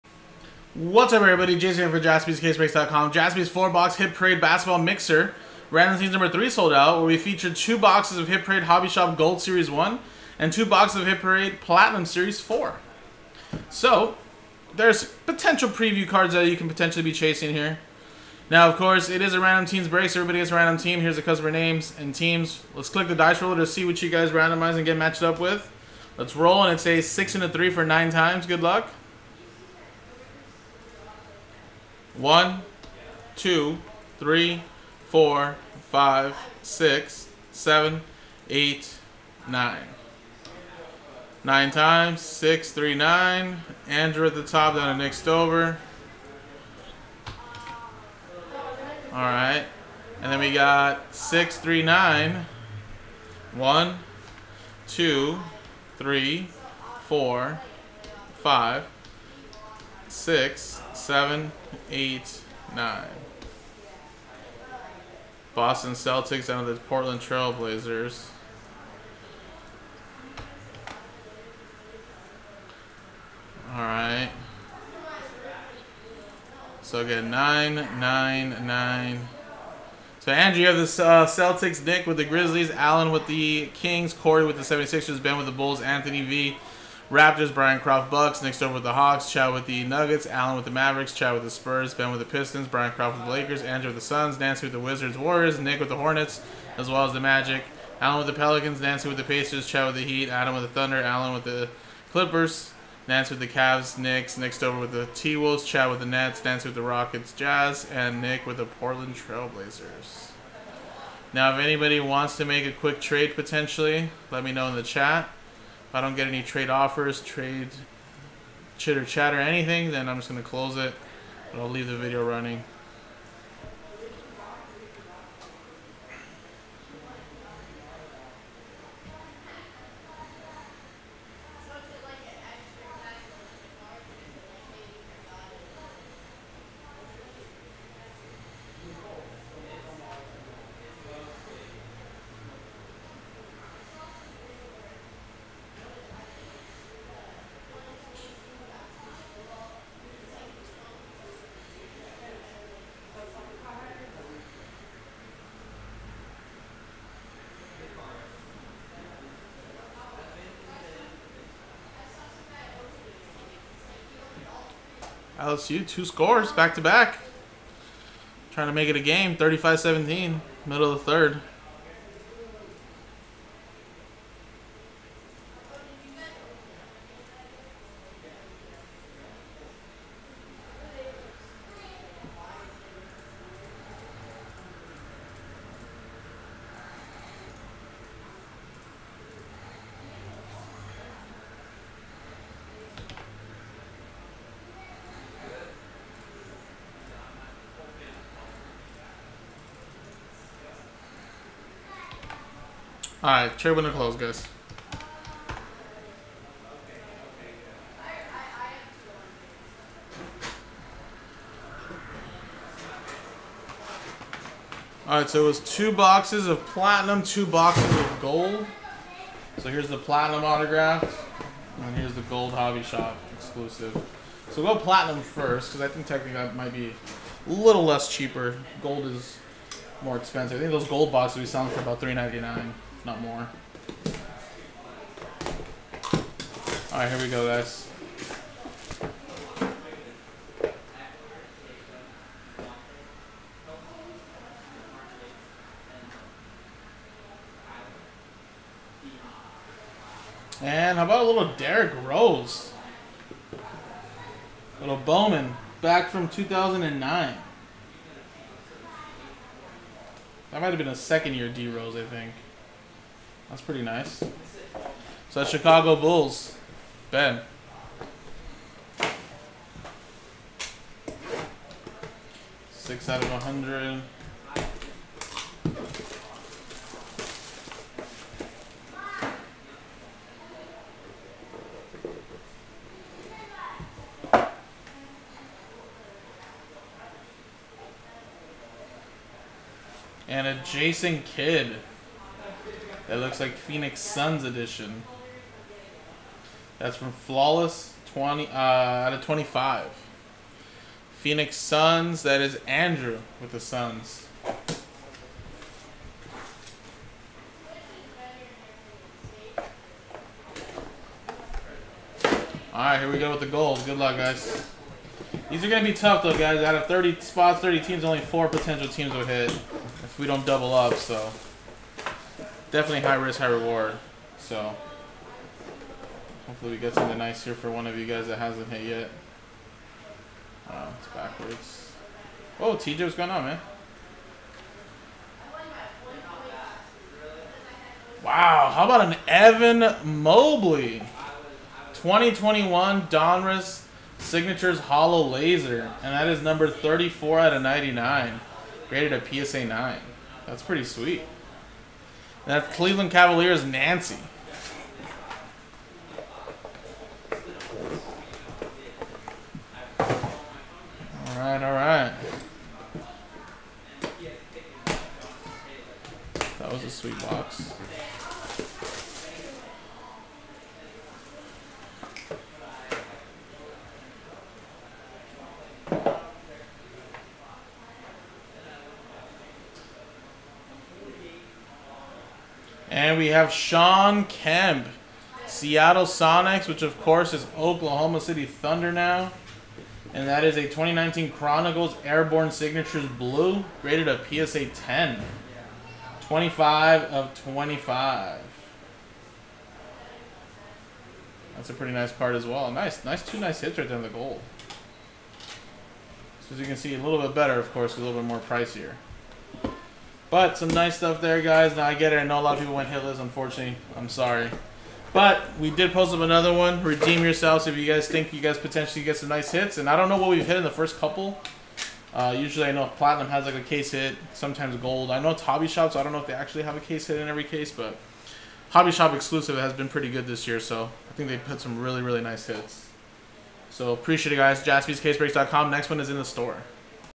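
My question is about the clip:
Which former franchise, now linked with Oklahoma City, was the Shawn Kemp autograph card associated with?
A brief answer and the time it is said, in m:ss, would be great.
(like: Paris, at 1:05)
Seattle Sonics, at 6:25.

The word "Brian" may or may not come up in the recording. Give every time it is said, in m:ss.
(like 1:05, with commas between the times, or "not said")
1:27, 1:32.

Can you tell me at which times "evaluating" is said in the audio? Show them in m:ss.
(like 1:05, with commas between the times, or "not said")
not said.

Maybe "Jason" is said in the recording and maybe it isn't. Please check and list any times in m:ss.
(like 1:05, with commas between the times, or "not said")
0:01, 4:50.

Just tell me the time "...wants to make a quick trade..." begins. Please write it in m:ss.
1:51.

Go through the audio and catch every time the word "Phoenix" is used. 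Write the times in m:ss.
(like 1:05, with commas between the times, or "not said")
4:53, 5:01.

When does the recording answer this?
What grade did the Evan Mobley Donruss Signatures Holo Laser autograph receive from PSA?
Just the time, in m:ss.
5:49.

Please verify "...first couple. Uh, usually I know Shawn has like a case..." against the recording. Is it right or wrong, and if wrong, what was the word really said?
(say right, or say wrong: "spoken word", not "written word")
wrong: "Platinum", not "Shawn".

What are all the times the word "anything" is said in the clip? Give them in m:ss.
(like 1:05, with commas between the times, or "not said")
1:59.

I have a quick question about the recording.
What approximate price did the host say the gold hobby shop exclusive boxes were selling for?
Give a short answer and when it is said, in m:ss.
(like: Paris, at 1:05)
399, at 3:51.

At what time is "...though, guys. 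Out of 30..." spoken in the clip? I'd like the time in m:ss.
5:16.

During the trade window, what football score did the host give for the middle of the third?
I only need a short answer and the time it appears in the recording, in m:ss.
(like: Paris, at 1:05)
35-17, at 2:49.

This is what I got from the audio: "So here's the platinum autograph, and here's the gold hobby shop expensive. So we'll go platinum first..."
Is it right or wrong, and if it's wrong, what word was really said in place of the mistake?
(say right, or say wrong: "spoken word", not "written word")
wrong: "exclusive", not "expensive".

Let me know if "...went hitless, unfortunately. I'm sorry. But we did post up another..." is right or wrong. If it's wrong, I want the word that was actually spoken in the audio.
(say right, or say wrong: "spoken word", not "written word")
right.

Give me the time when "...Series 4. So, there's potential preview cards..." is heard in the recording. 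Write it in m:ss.
0:12.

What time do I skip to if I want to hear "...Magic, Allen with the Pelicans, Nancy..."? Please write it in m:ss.
1:37.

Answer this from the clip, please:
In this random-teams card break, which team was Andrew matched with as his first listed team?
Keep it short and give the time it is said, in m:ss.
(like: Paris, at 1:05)
Boston Celtics, at 1:05.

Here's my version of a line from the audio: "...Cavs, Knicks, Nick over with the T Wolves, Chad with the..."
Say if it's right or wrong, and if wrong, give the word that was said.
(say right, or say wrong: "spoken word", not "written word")
right.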